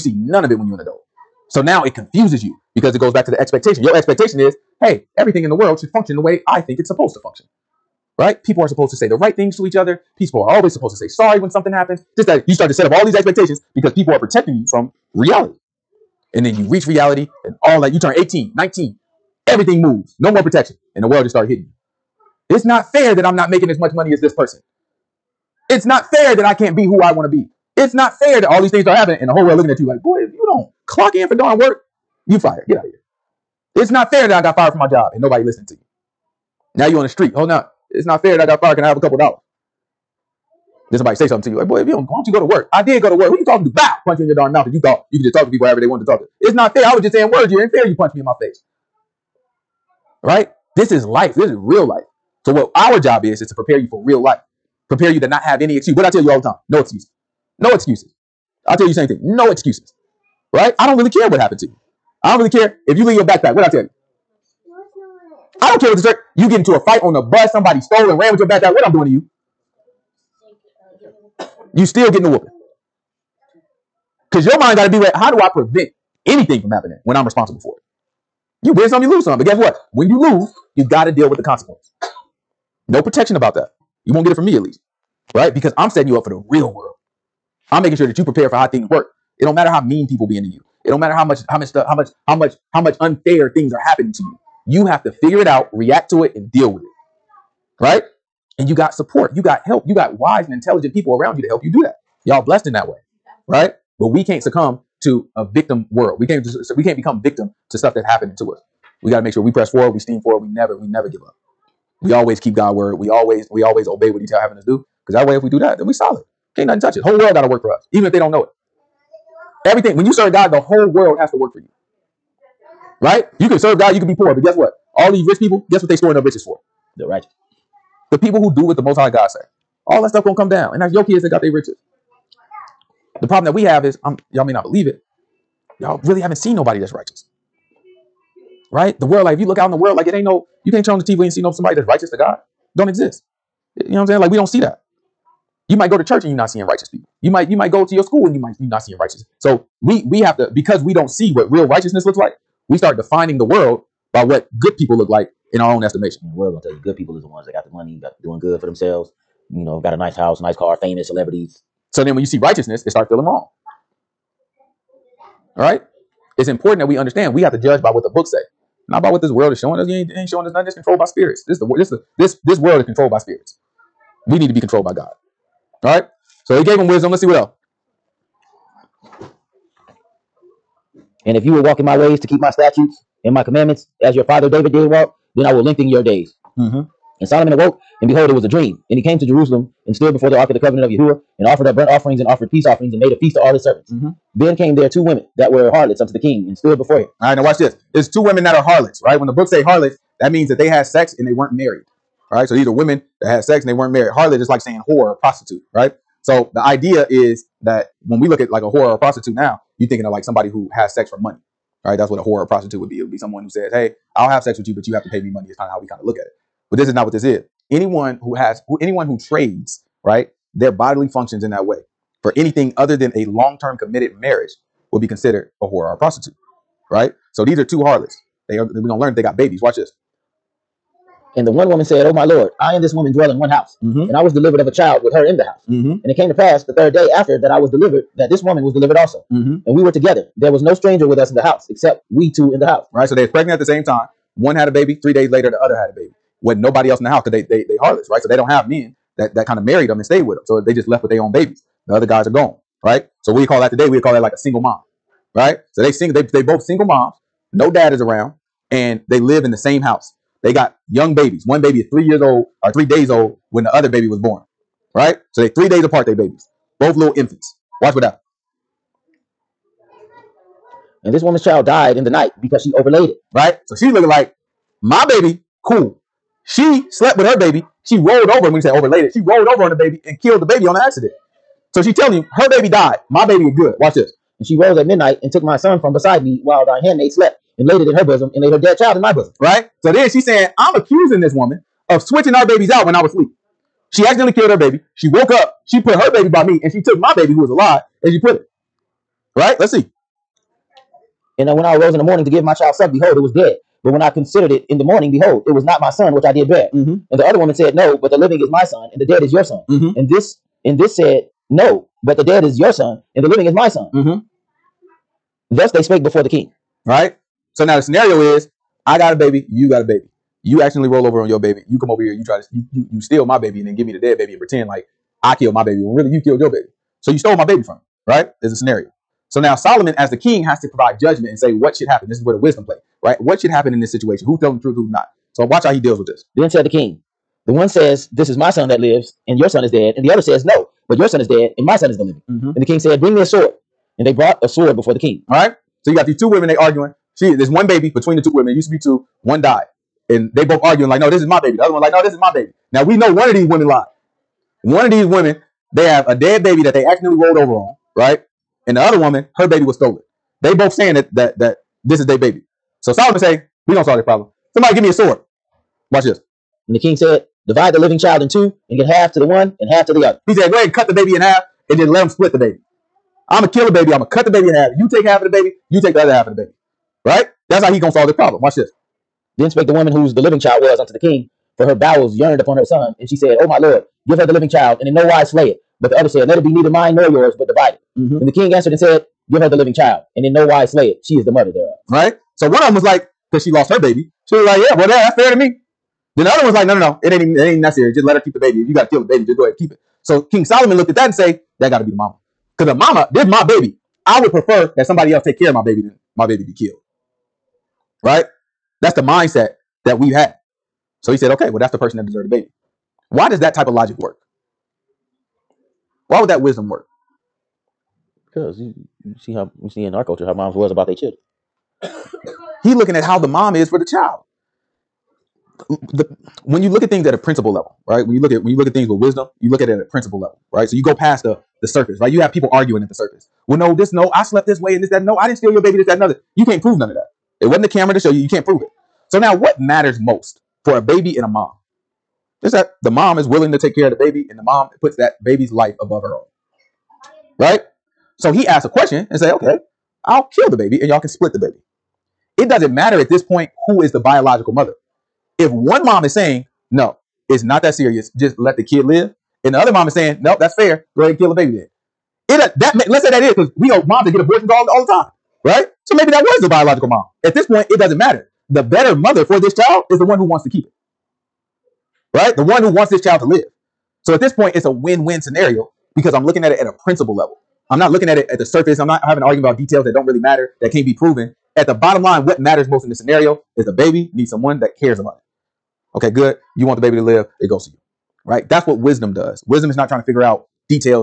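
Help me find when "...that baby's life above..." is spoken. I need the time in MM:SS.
07:24.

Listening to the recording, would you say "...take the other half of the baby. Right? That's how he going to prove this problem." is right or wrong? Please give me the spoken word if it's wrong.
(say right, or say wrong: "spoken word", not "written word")
wrong: "solve", not "prove".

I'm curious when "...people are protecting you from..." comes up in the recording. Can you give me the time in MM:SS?
00:13.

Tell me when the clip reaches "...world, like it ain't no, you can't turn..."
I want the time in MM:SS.
02:19.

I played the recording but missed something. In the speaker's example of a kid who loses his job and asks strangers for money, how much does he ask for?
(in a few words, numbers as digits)
a couple dollars.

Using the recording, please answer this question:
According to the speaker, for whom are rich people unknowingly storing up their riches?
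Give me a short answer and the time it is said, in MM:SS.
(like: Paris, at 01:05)
The righteous, at 02:06.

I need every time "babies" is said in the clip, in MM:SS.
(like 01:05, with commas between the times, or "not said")
03:49, 04:11, 04:21, 04:26, 04:52.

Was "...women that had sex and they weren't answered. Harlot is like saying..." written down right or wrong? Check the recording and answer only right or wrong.
wrong.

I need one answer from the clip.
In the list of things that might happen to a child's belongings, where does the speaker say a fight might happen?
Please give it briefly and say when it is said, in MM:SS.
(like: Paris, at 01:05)
on the bus, at 01:07.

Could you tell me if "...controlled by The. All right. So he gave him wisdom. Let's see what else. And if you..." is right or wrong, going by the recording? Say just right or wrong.
wrong.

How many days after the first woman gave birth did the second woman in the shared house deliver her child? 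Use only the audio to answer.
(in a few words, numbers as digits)
3.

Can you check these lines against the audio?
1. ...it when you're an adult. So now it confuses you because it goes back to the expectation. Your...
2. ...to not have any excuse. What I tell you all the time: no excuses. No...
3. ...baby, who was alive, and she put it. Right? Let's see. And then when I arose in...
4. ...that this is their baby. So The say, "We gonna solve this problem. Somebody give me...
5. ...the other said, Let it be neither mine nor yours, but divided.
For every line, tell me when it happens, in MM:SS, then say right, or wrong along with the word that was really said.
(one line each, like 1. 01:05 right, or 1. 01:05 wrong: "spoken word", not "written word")
1. 00:00 right
2. 00:55 right
3. 04:57 right
4. 06:01 wrong: "Solomon", not "The"
5. 06:25 right.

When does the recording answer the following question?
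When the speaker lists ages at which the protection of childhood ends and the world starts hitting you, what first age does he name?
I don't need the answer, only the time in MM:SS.
00:18.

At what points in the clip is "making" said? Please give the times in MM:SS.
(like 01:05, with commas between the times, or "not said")
00:23, 01:27.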